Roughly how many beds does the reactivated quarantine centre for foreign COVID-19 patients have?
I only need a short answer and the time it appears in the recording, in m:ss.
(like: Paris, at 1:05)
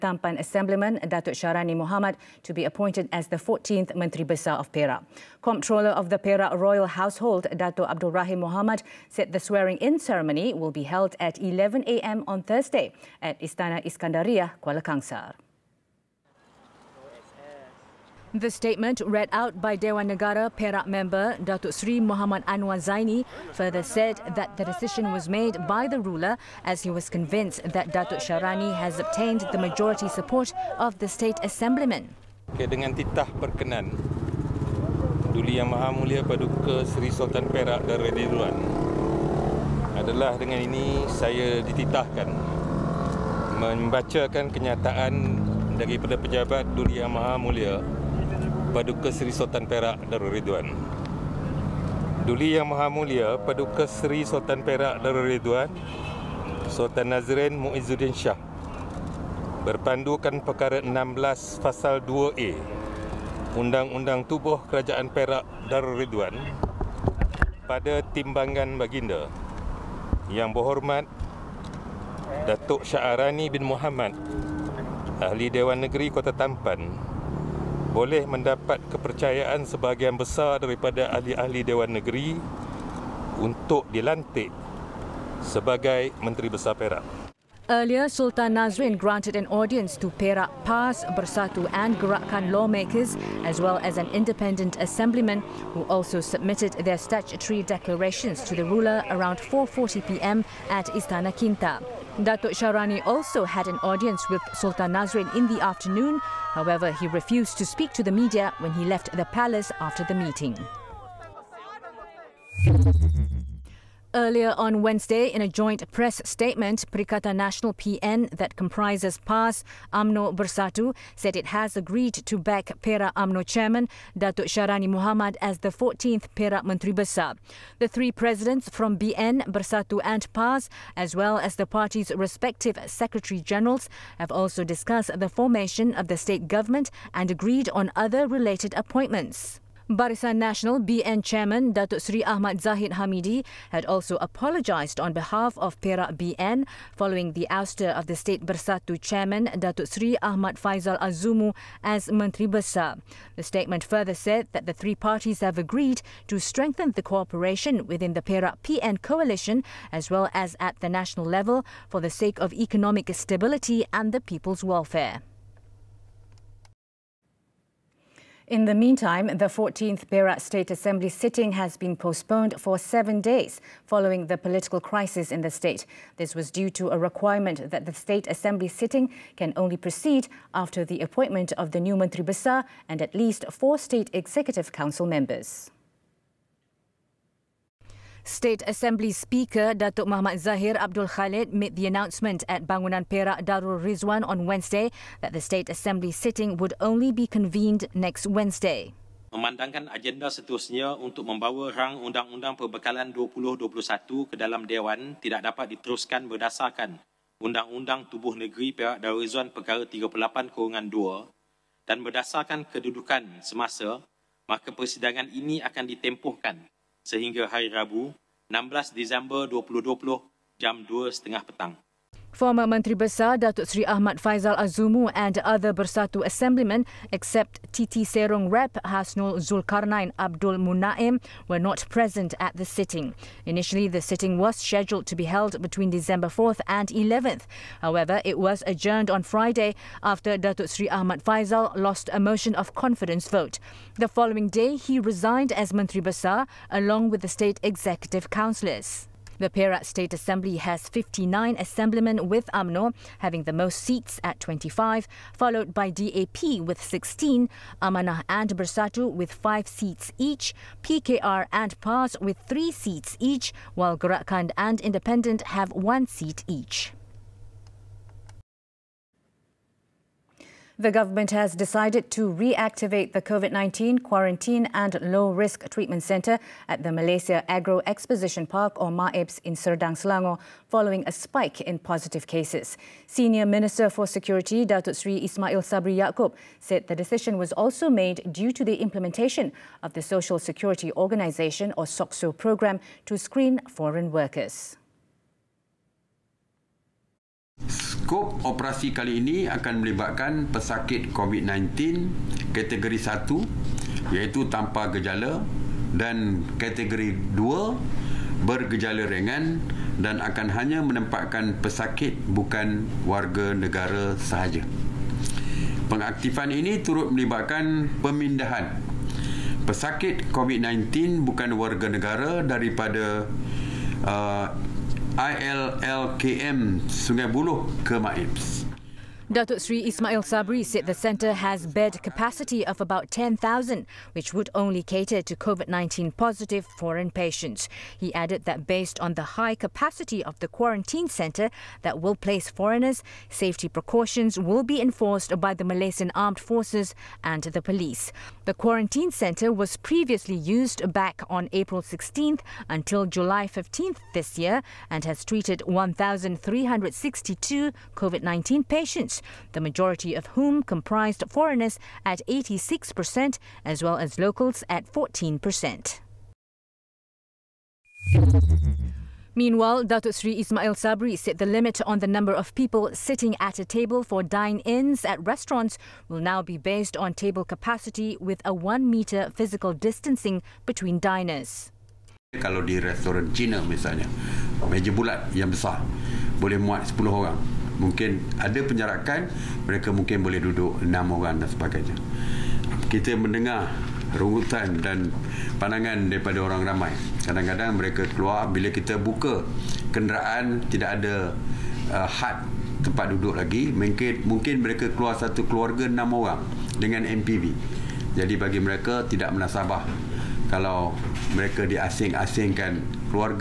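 10,000, at 5:33.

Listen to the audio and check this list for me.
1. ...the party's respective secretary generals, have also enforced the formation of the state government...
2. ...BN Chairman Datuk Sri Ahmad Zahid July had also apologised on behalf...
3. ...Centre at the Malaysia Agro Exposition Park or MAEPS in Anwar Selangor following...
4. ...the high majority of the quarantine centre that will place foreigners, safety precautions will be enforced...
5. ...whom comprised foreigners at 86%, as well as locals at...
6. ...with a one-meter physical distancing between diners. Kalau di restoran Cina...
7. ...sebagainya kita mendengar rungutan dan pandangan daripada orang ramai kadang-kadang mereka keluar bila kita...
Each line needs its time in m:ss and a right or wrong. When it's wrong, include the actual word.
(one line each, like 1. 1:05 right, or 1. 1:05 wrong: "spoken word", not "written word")
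1. 2:11 wrong: "discussed", not "enforced"
2. 2:20 wrong: "Hamidi", not "July"
3. 4:36 wrong: "Serdang", not "Anwar"
4. 5:39 wrong: "capacity", not "majority"
5. 6:00 right
6. 6:18 right
7. 6:31 right.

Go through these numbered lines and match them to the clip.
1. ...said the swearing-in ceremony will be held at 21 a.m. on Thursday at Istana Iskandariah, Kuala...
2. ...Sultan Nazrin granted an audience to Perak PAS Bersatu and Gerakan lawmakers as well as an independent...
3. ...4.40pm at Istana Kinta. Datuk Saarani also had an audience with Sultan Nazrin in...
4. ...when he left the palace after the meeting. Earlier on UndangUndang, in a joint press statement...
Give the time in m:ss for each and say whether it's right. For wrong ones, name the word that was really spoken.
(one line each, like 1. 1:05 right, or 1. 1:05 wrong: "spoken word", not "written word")
1. 0:09 wrong: "11", not "21"
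2. 1:28 right
3. 1:39 right
4. 1:48 wrong: "Wednesday", not "UndangUndang".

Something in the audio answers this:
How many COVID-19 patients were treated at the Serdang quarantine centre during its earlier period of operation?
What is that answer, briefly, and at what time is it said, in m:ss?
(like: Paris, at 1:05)
1,362, at 5:55.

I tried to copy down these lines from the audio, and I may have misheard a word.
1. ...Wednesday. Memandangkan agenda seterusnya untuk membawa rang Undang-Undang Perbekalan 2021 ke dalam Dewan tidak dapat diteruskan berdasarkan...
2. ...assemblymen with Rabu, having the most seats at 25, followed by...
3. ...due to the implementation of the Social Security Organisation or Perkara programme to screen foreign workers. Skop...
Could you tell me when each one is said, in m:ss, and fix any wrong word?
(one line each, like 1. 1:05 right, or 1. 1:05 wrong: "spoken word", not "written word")
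1. 3:18 right
2. 4:11 wrong: "UMNO", not "Rabu"
3. 4:48 wrong: "SOCSO", not "Perkara".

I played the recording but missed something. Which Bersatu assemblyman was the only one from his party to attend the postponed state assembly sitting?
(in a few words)
Hasnul Zulkarnain Abdul Munaim.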